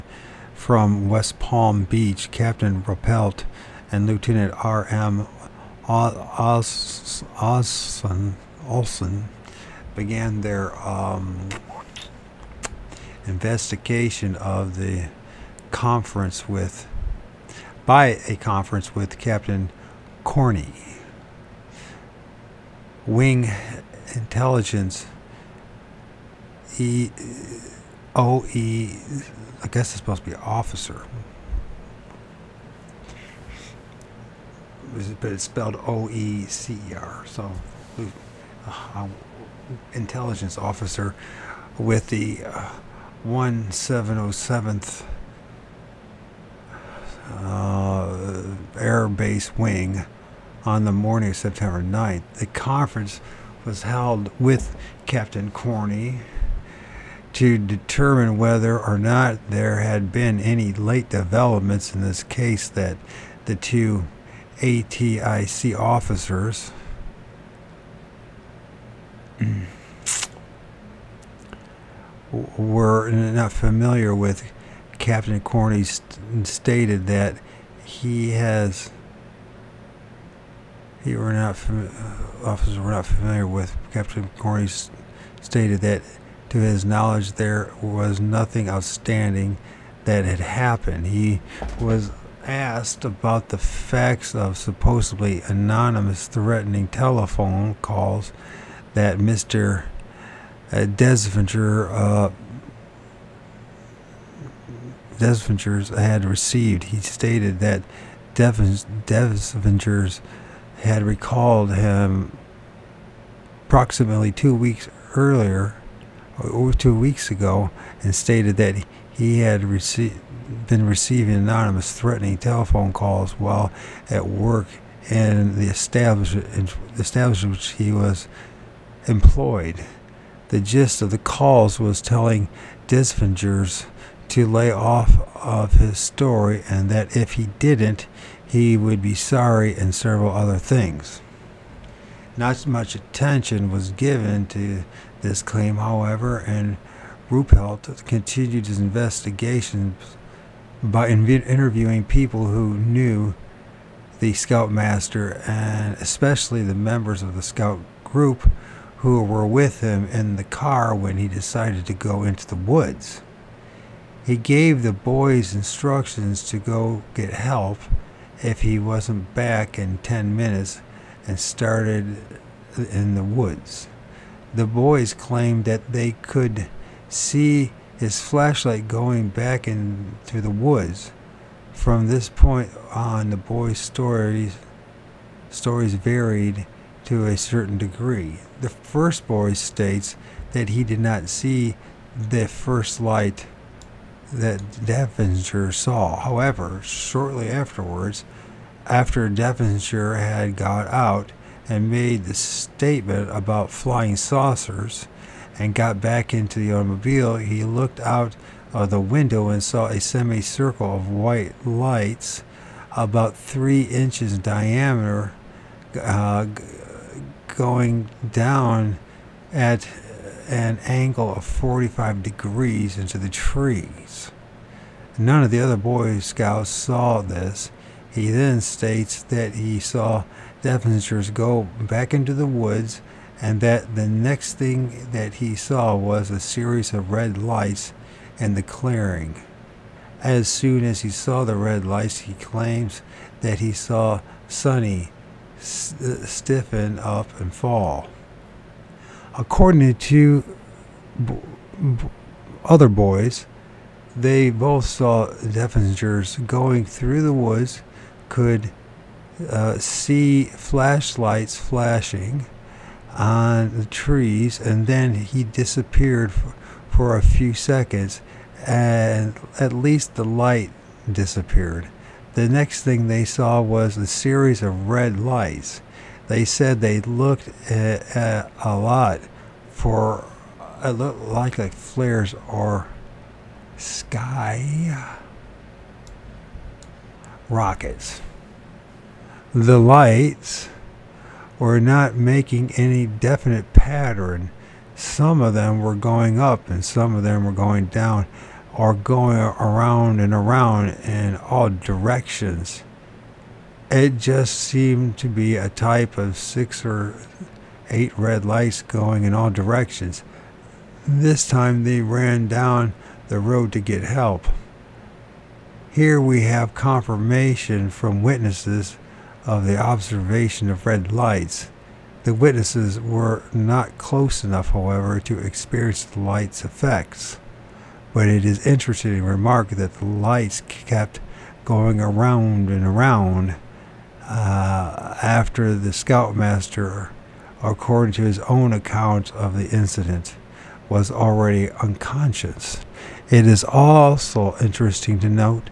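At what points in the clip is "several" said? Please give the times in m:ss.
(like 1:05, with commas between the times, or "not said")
2:19.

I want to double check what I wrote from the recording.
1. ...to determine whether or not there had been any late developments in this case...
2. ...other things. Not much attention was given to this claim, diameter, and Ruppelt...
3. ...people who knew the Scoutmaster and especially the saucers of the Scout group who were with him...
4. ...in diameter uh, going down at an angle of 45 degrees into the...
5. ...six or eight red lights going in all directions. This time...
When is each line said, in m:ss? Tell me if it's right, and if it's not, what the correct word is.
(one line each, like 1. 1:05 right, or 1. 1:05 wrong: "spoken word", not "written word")
1. 0:57 right
2. 2:20 wrong: "however", not "diameter"
3. 2:32 wrong: "members", not "saucers"
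4. 3:34 right
5. 5:06 right.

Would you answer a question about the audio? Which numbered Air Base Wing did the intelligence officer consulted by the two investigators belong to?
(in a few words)
1707th.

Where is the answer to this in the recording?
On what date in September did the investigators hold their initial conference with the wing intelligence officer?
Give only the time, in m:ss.
0:51.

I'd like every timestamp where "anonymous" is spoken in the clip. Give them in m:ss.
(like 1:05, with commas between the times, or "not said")
1:35, 2:01.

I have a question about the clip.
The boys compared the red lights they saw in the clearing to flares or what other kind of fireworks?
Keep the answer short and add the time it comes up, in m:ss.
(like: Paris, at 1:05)
sky rockets, at 4:43.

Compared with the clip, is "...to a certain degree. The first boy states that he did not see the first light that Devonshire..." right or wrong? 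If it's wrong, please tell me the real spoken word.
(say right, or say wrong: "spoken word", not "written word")
right.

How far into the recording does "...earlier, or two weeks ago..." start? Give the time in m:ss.
1:55.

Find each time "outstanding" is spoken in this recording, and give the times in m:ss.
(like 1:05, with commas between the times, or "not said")
1:28.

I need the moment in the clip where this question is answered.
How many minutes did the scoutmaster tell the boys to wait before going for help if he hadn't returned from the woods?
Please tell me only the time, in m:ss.
2:50.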